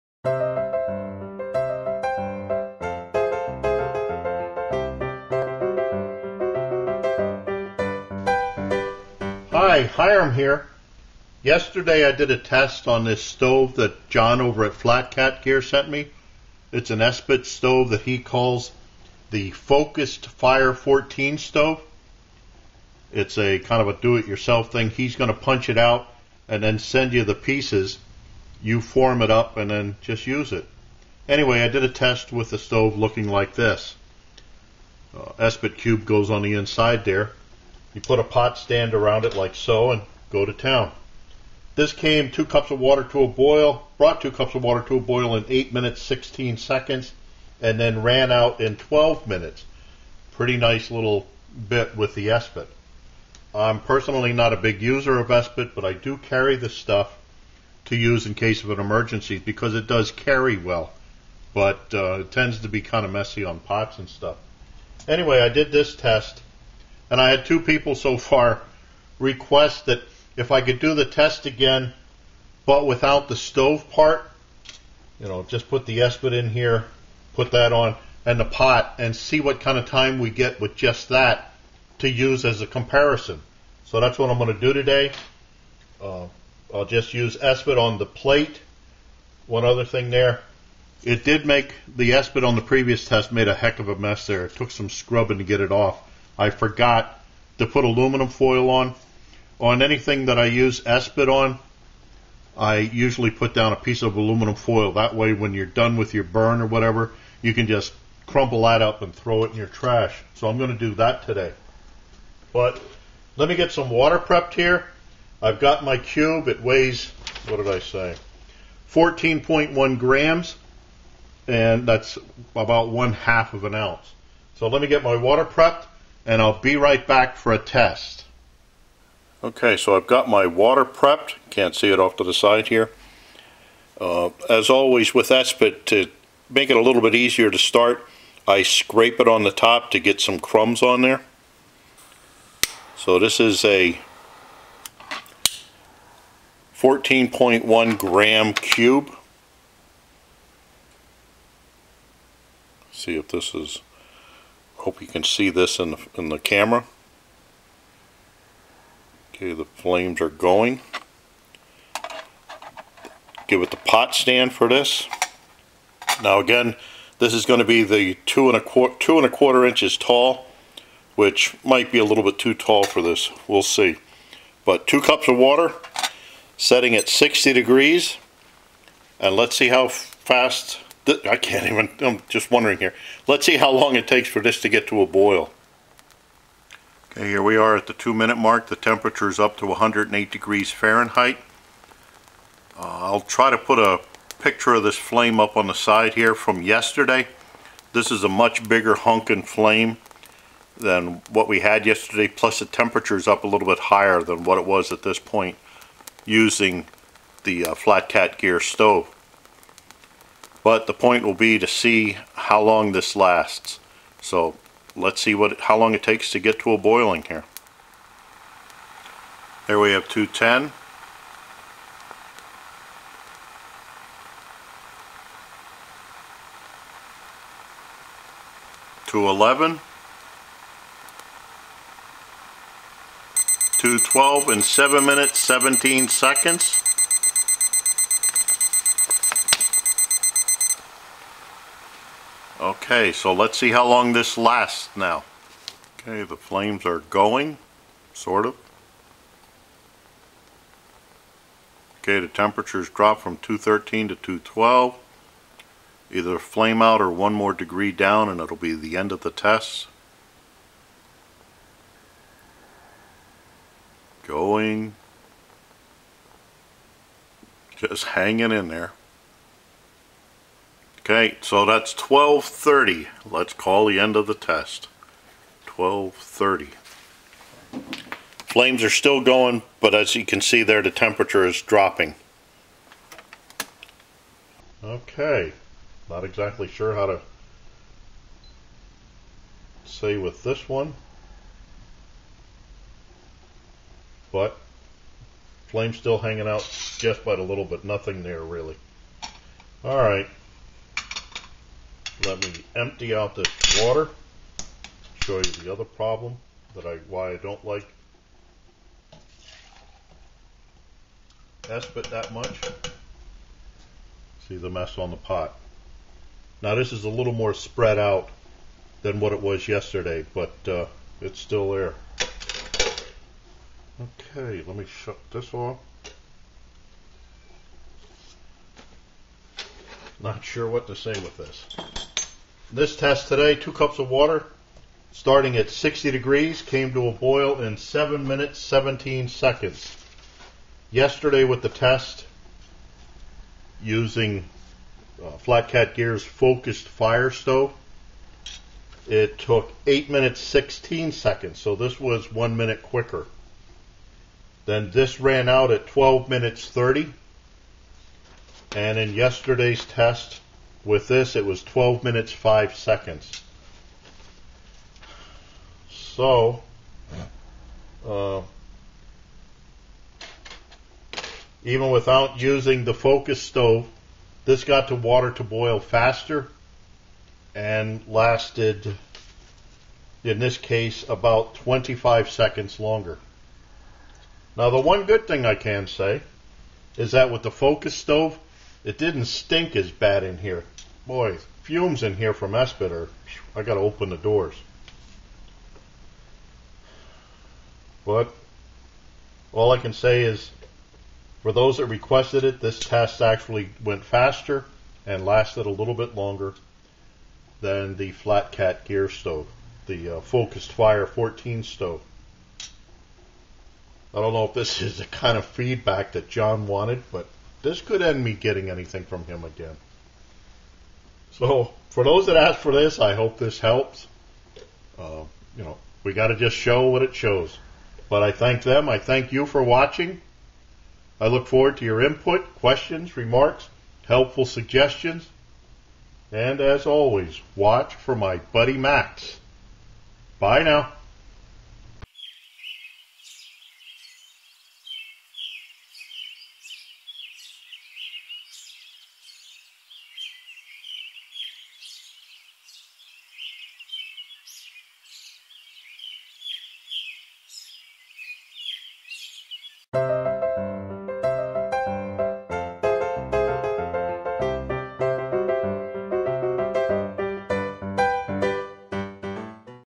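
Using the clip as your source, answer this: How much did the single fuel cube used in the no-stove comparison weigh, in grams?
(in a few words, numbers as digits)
14.1 grams.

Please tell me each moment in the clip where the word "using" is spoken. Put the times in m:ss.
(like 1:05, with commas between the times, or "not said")
3:26, 5:43, 6:12.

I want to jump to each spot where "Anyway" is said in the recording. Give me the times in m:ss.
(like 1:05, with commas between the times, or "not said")
0:31, 1:05.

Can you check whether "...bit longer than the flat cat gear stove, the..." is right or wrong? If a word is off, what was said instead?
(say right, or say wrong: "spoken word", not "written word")
right.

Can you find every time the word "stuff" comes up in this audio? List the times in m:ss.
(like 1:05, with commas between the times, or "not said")
0:56, 1:04.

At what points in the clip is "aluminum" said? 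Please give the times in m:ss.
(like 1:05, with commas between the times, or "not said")
1:37, 1:44.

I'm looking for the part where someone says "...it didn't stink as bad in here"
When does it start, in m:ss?
6:28.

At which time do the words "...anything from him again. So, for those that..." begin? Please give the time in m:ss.
6:58.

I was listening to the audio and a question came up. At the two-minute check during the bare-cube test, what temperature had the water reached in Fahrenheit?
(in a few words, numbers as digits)
108 degrees.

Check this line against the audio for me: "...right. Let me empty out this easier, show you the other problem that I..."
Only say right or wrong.
wrong.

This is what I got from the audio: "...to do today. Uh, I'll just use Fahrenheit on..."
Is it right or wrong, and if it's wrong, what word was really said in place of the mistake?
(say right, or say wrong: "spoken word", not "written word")
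wrong: "Esbit", not "Fahrenheit".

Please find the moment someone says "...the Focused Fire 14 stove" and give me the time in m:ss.
0:19.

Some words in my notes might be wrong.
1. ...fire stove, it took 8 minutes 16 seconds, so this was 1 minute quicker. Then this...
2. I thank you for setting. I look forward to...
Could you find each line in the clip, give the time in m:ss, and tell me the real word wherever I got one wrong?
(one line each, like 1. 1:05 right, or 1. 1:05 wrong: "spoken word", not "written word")
1. 5:46 right
2. 7:08 wrong: "watching", not "setting".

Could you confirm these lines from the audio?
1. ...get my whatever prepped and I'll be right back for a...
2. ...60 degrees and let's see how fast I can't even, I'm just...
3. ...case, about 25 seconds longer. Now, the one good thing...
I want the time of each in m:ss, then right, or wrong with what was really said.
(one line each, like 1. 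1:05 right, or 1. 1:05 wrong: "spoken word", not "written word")
1. 2:04 wrong: "water", not "whatever"
2. 2:57 right
3. 6:20 right.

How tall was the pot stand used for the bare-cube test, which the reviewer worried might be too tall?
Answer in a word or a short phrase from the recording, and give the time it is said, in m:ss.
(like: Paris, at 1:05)
2 1/4 inches, at 2:48.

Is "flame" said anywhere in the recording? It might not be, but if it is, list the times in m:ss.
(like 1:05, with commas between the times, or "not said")
2:39, 3:14, 3:19, 4:06, 4:16, 4:38, 4:55.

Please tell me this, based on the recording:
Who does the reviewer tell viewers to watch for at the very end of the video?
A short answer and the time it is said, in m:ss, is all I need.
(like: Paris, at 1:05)
Max, at 7:18.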